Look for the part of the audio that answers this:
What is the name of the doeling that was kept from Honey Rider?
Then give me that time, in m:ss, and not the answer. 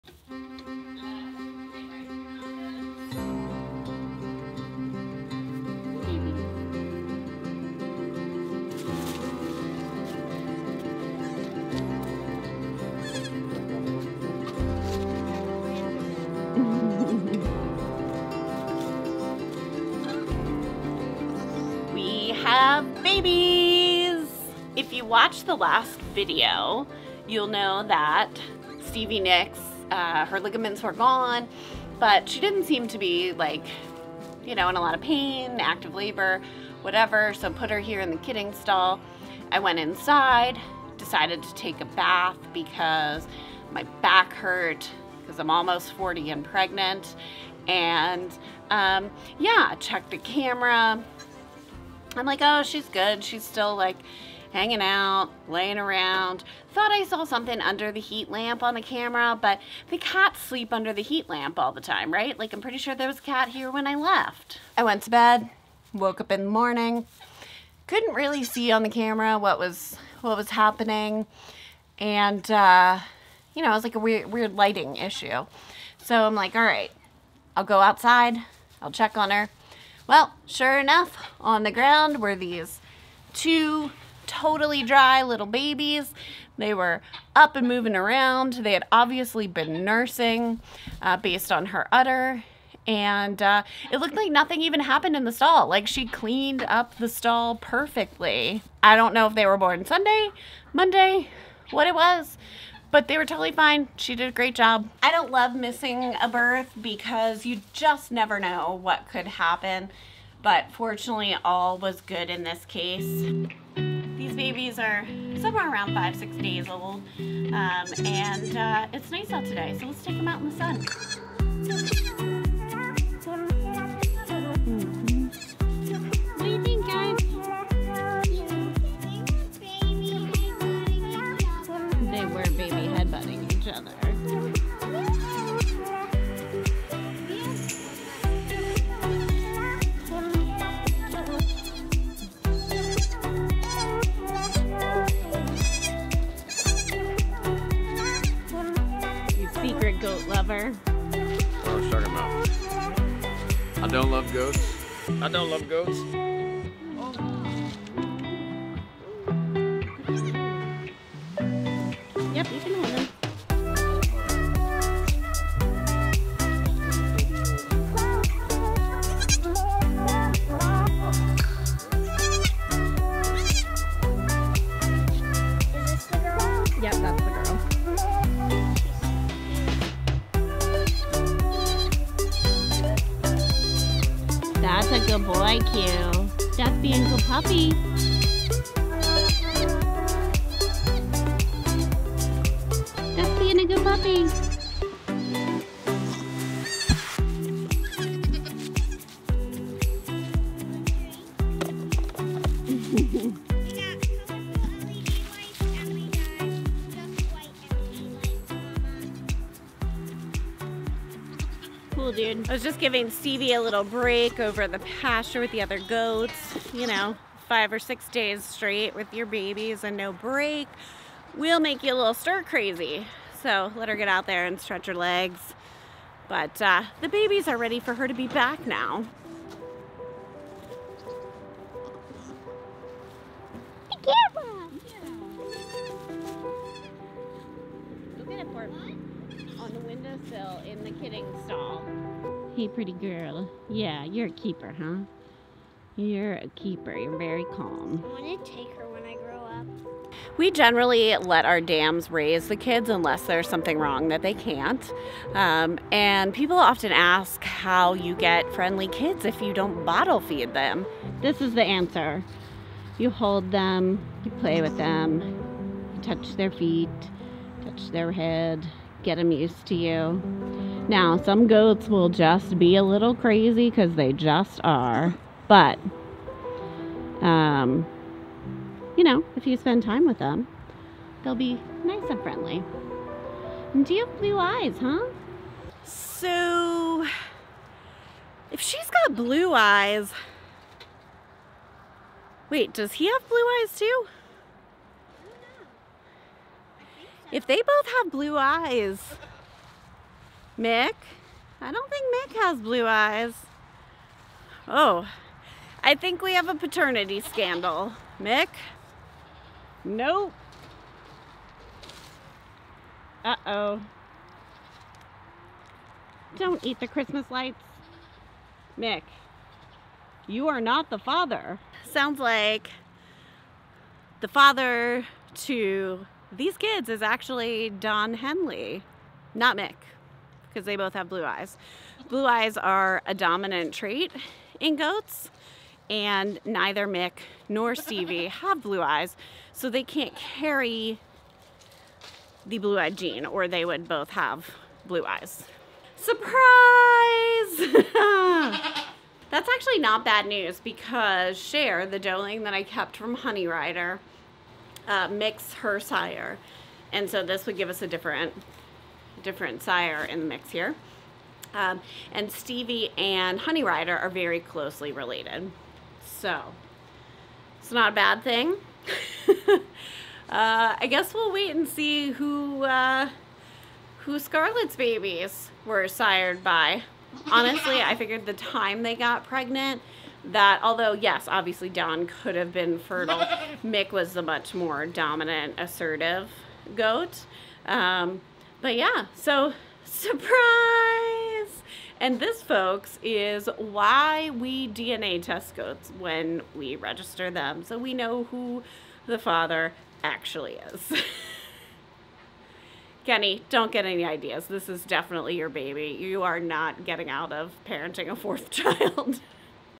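5:51.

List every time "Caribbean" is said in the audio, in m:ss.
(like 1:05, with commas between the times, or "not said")
not said.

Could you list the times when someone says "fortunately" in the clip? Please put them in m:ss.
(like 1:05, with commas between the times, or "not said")
1:50.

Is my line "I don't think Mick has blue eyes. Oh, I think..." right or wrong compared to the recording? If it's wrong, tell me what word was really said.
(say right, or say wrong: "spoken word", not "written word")
right.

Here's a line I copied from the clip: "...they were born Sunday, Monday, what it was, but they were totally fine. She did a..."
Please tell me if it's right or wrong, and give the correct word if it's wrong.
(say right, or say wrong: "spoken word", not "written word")
right.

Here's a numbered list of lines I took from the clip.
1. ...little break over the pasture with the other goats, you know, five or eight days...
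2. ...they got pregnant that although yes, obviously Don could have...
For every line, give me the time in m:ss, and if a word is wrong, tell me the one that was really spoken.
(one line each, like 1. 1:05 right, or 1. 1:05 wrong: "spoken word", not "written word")
1. 3:33 wrong: "six", not "eight"
2. 6:18 right.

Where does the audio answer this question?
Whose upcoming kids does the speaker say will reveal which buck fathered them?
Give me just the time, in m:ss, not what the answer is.
6:14.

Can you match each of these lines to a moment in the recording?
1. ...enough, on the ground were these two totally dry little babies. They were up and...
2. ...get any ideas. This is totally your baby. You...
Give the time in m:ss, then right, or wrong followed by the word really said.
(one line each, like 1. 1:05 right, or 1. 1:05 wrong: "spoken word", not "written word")
1. 1:20 right
2. 6:43 wrong: "definitely", not "totally".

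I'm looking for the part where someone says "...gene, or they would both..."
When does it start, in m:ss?
5:42.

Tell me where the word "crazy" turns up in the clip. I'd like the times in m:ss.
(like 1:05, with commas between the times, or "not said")
3:42, 4:33.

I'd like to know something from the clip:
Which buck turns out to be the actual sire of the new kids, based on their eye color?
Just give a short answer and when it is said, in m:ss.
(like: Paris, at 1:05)
Don Henley, at 5:27.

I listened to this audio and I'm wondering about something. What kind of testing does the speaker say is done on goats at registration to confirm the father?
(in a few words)
DNA test.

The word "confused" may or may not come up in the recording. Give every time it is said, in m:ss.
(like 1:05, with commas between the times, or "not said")
not said.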